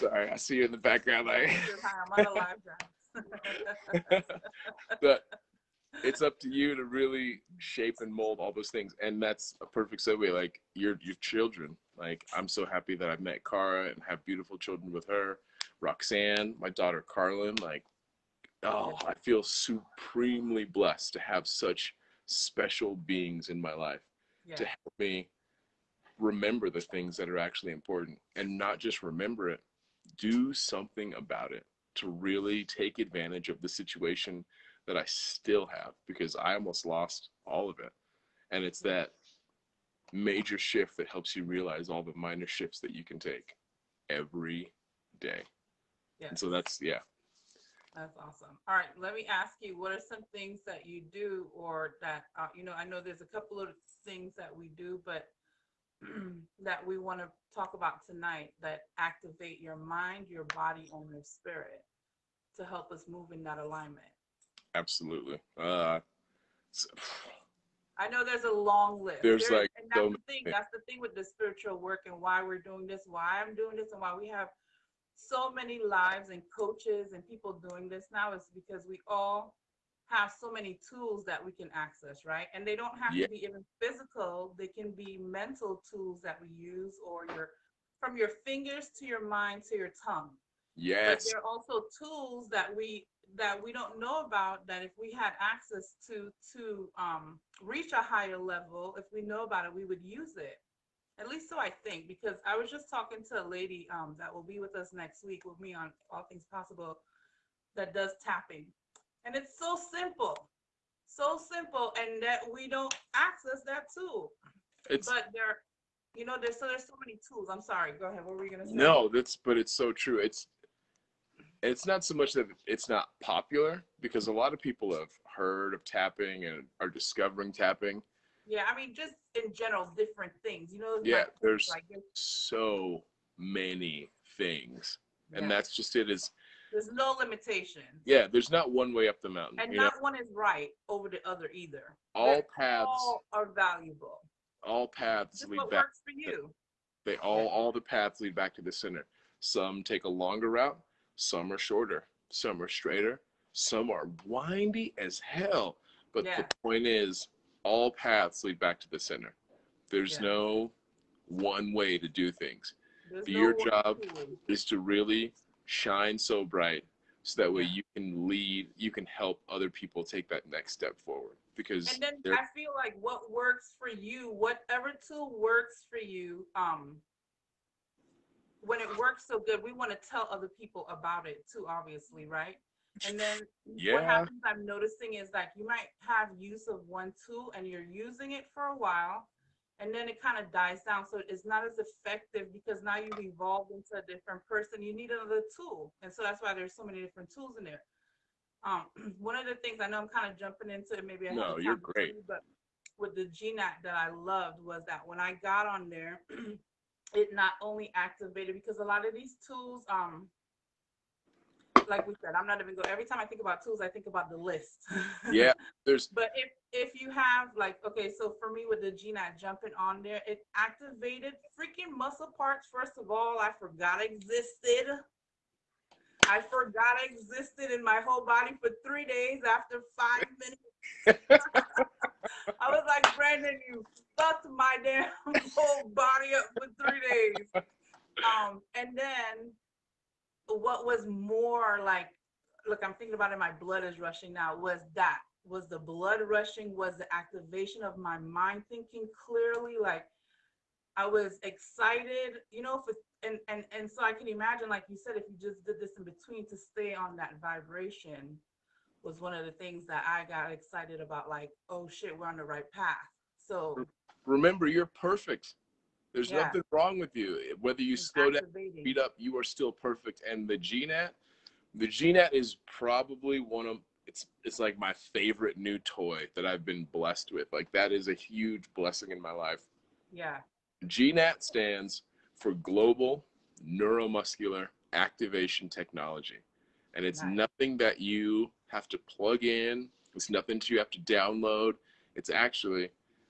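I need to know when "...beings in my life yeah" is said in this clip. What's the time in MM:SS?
00:22.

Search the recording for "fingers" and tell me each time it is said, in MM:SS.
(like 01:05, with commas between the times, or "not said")
01:28.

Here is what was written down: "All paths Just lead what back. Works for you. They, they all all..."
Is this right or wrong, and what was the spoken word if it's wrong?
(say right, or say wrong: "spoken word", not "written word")
right.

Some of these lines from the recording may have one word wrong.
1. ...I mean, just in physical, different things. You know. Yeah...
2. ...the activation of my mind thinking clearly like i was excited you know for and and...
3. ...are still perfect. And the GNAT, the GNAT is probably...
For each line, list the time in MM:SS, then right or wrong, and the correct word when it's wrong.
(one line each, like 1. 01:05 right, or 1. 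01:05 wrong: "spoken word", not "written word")
1. 02:08 wrong: "general", not "physical"
2. 04:06 right
3. 04:29 right.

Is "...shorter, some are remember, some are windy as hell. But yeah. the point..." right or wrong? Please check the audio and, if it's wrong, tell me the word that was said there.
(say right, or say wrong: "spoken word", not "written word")
wrong: "straighter", not "remember".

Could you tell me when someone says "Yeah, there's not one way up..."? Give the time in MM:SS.
02:18.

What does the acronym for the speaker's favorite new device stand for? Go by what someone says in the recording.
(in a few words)
Global Neuromuscular Activation Technology.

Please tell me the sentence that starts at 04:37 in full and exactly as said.
Like that is a huge blessing in my life.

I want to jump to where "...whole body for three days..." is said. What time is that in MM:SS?
03:48.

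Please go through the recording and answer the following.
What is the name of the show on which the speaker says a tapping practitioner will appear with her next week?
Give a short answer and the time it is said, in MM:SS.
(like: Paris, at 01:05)
All Things Possible, at 01:46.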